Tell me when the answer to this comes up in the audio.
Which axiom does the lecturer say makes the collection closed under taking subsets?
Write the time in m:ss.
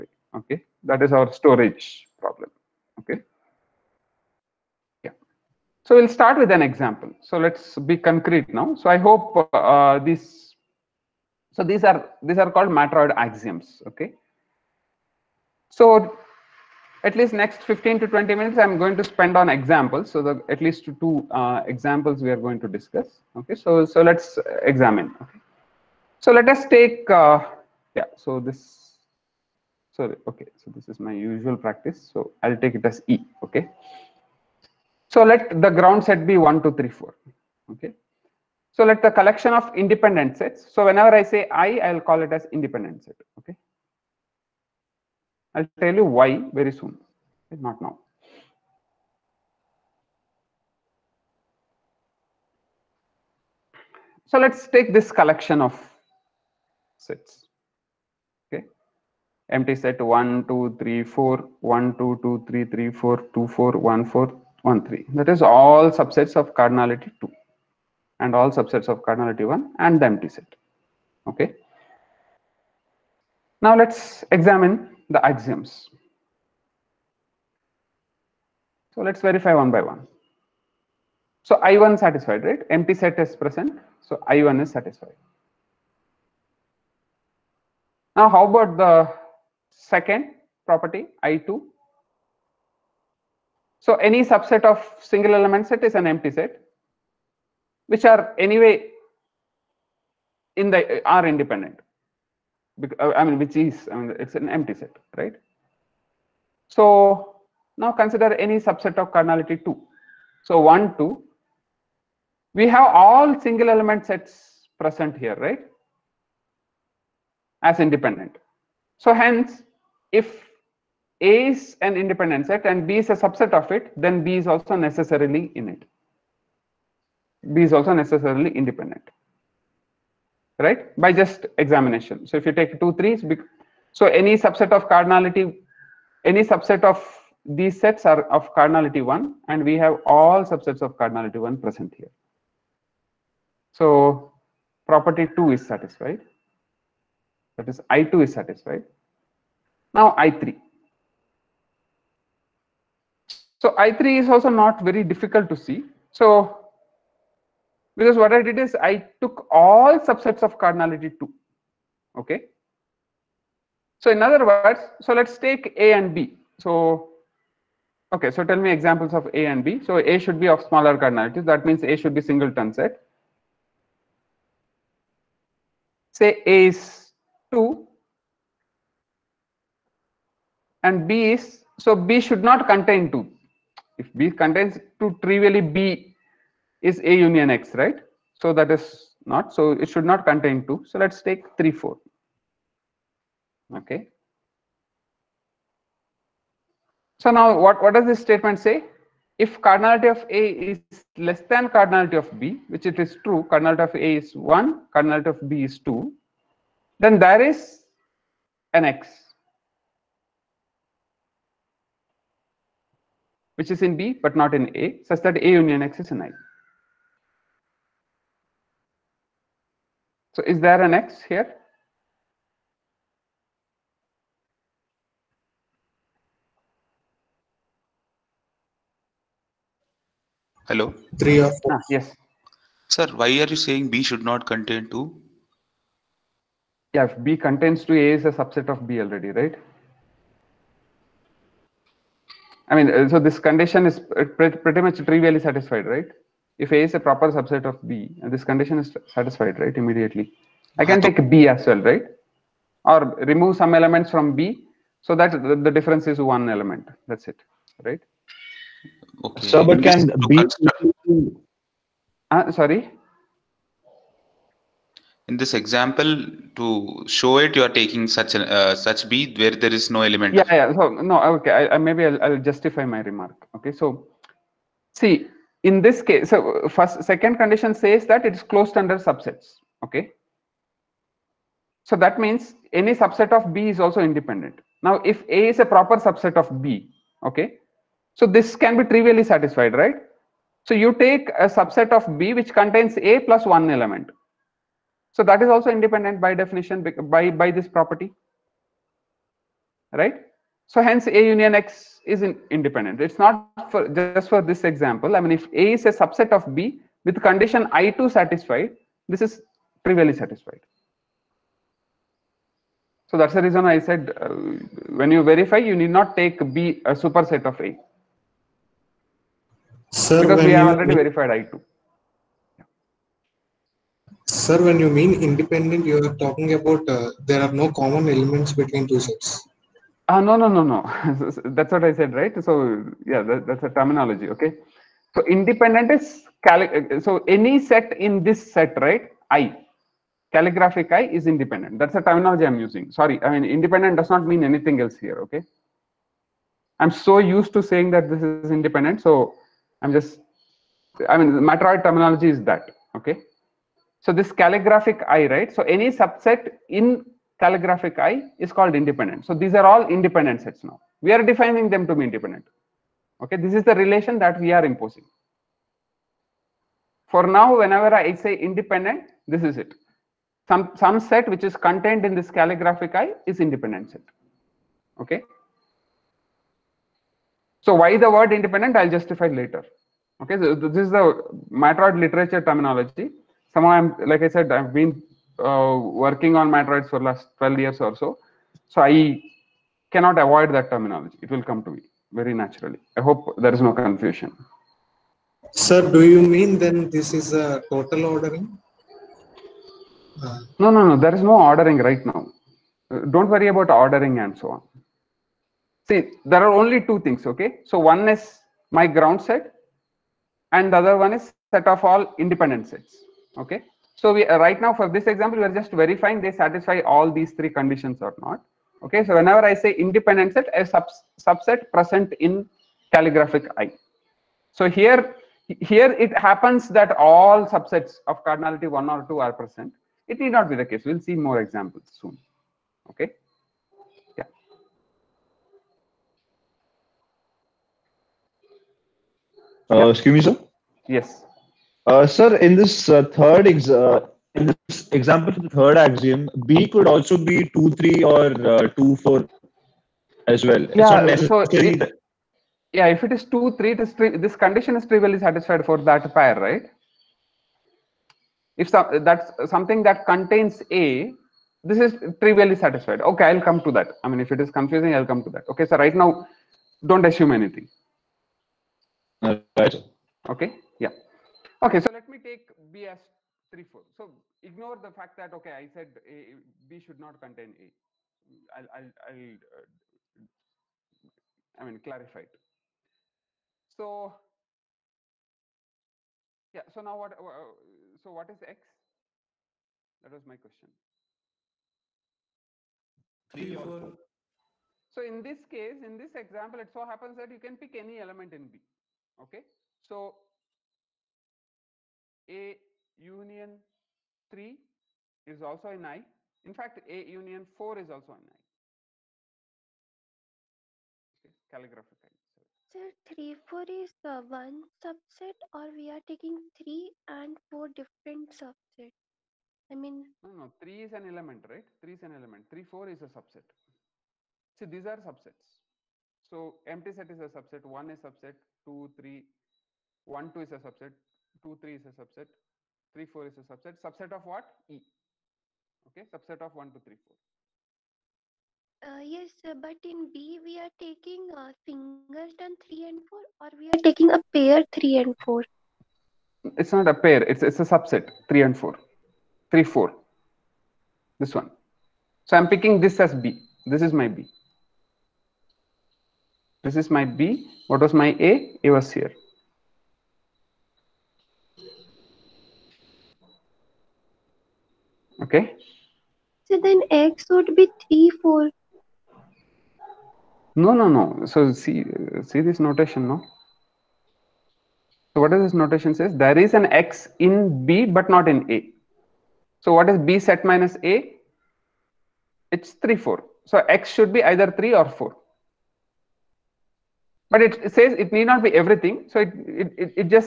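4:37.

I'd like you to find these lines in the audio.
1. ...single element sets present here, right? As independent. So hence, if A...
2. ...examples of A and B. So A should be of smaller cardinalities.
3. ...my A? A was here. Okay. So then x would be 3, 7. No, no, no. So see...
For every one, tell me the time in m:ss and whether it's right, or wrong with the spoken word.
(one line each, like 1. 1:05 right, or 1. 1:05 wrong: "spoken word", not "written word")
1. 1:53 right
2. 2:48 right
3. 9:17 wrong: "4", not "7".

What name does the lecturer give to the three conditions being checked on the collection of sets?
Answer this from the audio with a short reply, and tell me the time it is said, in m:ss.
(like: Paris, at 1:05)
matroid axioms, at 0:12.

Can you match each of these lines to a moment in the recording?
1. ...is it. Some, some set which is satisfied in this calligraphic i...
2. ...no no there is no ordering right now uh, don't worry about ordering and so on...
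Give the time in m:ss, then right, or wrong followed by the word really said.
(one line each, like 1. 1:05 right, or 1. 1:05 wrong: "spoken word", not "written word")
1. 6:09 wrong: "contained", not "satisfied"
2. 6:40 right.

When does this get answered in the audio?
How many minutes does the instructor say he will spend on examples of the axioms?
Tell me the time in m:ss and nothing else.
0:17.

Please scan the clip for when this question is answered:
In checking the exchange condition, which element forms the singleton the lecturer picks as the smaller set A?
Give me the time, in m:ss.
2:56.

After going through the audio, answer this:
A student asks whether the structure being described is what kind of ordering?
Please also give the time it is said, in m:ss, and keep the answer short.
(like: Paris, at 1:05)
total ordering, at 6:37.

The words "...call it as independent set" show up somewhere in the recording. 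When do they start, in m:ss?
0:41.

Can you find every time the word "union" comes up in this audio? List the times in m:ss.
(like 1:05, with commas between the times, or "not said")
3:07, 3:35, 5:01, 8:22, 8:27.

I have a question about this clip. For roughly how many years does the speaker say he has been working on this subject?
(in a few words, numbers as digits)
12.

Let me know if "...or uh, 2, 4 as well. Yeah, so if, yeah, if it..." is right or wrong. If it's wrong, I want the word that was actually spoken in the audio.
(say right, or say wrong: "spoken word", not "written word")
right.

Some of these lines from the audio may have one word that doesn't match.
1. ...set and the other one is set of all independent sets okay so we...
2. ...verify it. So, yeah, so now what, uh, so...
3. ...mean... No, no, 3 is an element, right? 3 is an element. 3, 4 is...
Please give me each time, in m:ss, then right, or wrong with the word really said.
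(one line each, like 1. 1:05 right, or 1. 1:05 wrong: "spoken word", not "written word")
1. 6:49 right
2. 8:01 wrong: "clarify", not "verify"
3. 8:39 right.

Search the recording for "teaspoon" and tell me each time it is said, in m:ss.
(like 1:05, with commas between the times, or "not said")
not said.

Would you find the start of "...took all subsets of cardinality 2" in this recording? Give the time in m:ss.
2:39.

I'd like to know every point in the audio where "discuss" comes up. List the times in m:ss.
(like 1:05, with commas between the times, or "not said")
0:22.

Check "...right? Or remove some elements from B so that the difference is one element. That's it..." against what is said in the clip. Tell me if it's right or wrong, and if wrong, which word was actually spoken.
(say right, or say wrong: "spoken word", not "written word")
right.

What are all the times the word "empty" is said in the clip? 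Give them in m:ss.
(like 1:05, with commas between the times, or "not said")
0:59, 1:10, 1:22, 1:36, 1:44, 8:46.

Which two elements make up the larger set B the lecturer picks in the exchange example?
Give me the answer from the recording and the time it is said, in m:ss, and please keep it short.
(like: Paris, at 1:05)
3, 4, at 3:10.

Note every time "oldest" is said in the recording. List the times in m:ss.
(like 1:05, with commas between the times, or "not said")
not said.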